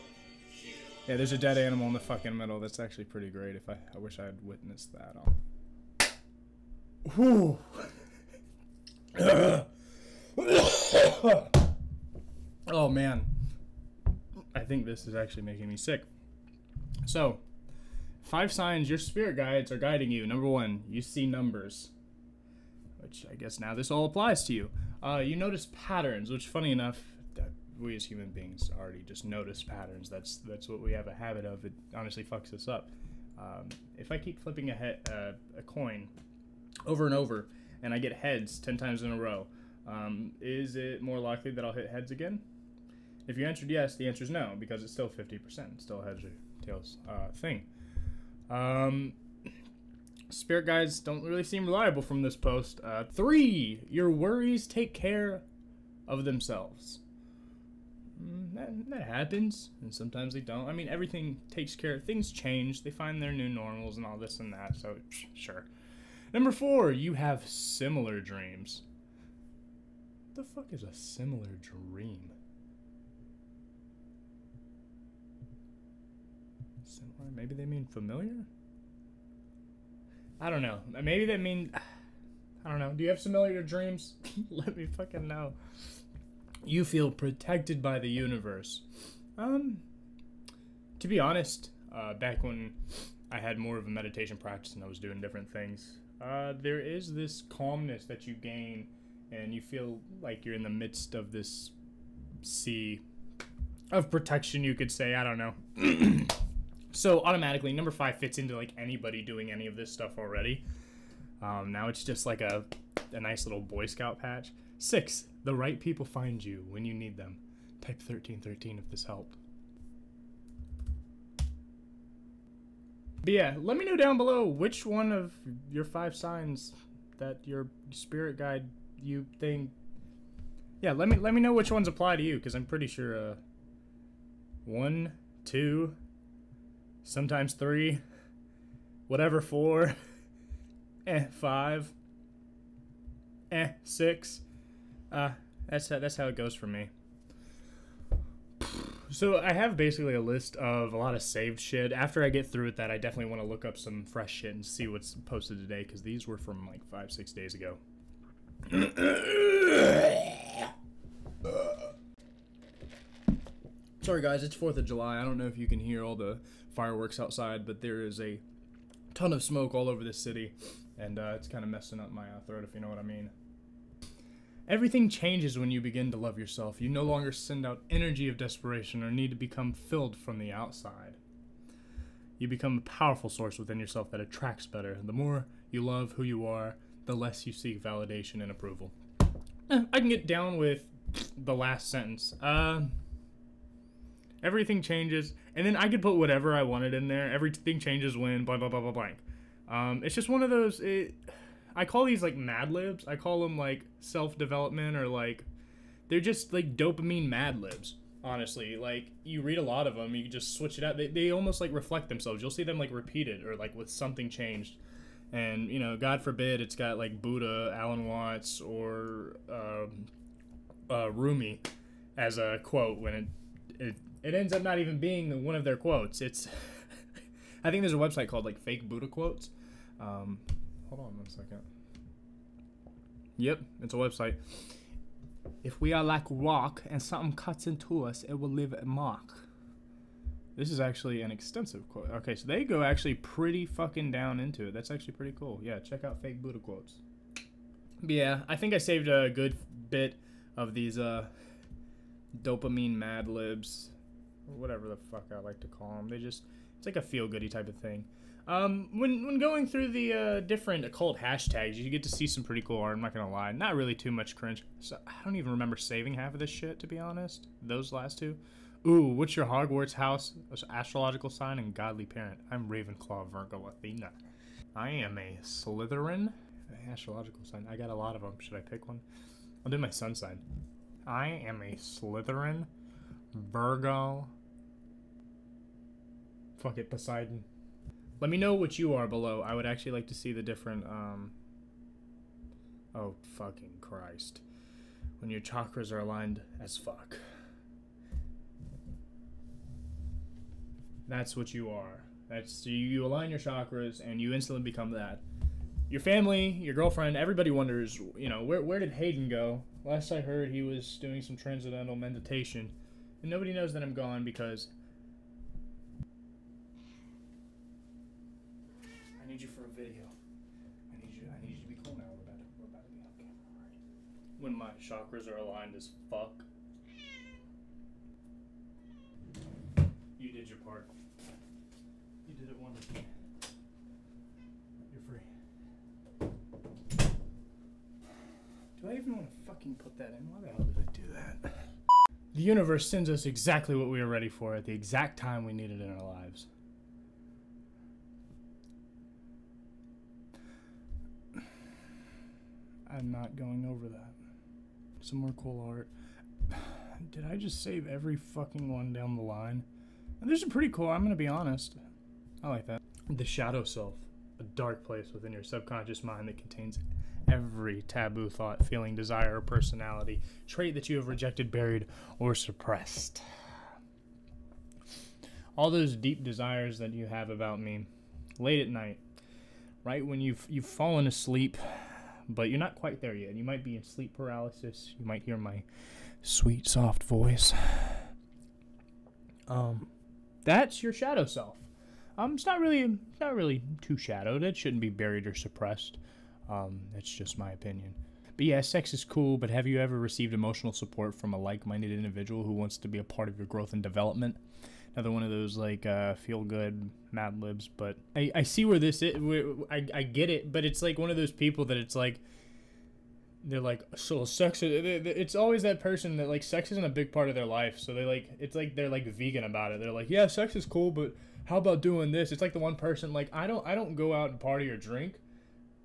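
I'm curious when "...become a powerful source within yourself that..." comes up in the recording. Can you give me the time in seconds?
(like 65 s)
182 s.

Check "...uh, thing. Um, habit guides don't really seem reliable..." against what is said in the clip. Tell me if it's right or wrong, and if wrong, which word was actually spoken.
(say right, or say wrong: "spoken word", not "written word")
wrong: "spirit", not "habit".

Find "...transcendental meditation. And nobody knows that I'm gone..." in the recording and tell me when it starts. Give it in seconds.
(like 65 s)
311 s.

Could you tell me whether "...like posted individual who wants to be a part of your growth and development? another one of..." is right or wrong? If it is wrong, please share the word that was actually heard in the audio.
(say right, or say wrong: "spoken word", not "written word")
wrong: "minded", not "posted".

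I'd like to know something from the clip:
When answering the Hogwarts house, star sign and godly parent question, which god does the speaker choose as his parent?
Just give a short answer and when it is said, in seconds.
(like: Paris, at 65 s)
Poseidon, at 286 s.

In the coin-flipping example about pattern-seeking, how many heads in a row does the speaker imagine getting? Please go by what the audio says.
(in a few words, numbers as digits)
10.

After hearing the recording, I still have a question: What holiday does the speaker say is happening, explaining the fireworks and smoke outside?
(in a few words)
4th of July.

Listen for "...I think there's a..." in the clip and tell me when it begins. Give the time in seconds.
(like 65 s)
227 s.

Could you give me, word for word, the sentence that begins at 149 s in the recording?
So I have basically a list of a lot of saved shit.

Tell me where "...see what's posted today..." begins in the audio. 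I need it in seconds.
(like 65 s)
154 s.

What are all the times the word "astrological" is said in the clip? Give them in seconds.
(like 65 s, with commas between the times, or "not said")
270 s, 276 s.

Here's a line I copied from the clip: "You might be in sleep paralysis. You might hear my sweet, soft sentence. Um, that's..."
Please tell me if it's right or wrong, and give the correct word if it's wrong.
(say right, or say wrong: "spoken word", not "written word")
wrong: "voice", not "sentence".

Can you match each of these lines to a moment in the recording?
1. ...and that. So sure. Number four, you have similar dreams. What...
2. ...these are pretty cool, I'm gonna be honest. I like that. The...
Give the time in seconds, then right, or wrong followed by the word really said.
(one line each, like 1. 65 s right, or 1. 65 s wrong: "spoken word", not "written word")
1. 64 s right
2. 360 s right.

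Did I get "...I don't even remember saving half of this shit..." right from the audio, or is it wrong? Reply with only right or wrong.
right.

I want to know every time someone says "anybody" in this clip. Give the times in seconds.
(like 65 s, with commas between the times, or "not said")
108 s.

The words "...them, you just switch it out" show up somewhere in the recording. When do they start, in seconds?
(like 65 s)
209 s.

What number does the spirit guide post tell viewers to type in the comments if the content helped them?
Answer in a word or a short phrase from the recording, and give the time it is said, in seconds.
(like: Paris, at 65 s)
1313, at 117 s.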